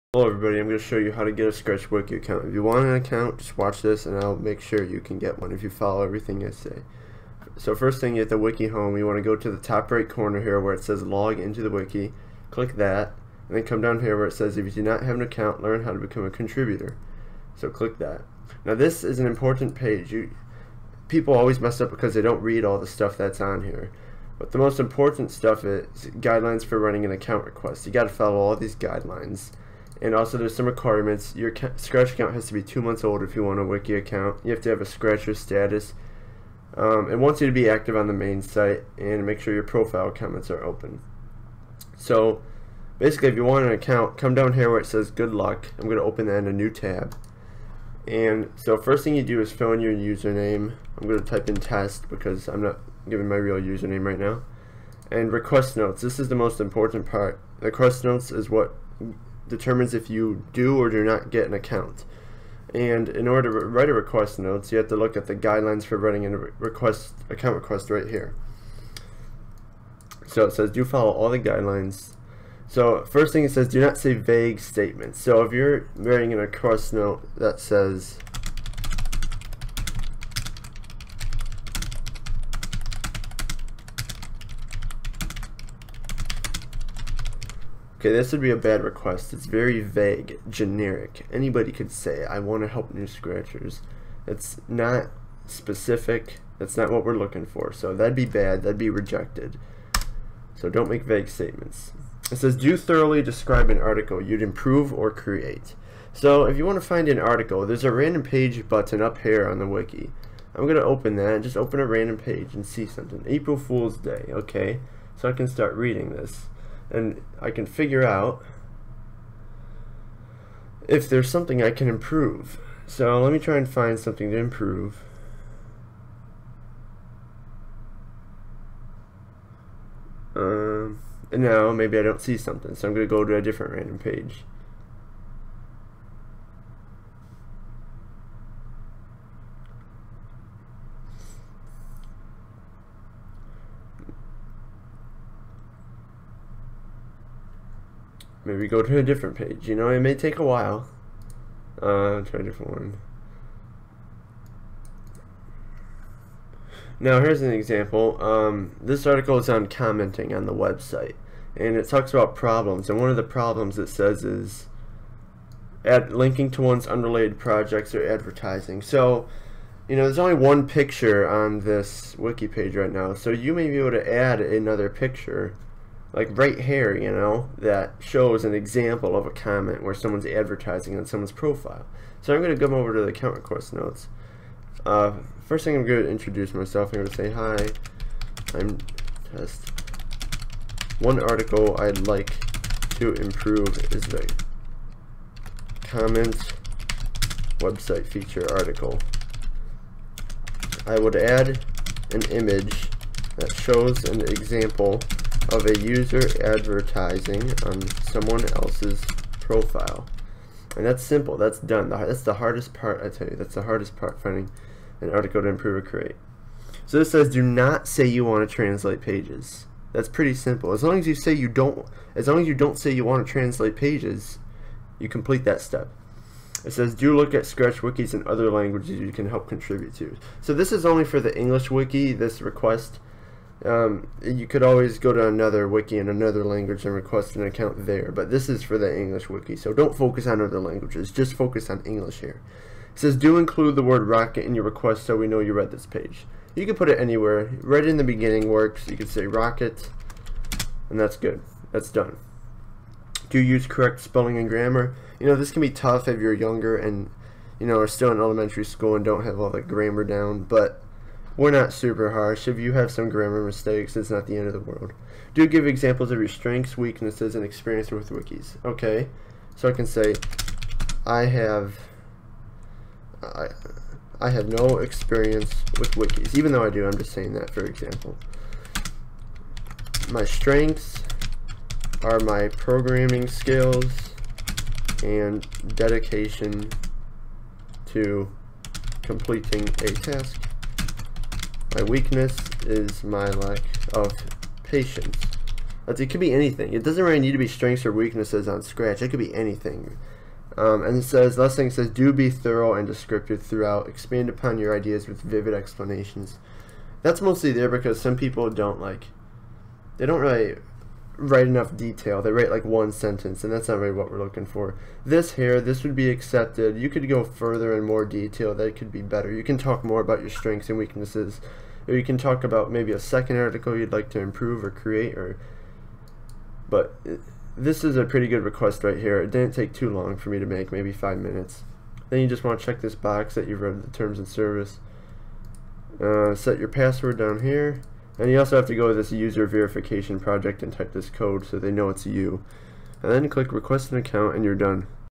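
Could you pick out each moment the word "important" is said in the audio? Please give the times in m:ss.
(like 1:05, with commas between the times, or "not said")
0:19, 0:24, 0:56.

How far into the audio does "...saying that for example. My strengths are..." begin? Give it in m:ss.
4:37.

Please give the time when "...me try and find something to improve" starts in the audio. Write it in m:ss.
2:03.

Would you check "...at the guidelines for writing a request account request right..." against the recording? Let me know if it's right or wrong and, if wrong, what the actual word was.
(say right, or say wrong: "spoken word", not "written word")
right.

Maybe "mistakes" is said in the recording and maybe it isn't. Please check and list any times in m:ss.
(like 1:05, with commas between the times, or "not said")
4:23.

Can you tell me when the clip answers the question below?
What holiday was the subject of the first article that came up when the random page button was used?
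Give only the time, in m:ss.
1:53.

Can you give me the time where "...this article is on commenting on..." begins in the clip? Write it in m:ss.
2:38.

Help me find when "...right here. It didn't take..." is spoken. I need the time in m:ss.
5:28.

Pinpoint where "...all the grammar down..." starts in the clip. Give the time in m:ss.
4:19.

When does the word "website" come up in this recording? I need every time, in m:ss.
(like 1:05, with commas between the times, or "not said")
2:40, 3:17.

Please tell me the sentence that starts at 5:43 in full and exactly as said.
And then click request an account and you're done.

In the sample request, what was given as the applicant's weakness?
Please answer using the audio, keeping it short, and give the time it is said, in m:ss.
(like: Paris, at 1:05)
lack of patience, at 4:53.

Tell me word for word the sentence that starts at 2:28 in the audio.
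Maybe go to a different page.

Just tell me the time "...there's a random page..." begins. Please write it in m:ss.
1:47.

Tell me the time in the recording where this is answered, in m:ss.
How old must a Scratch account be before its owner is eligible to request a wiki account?
0:32.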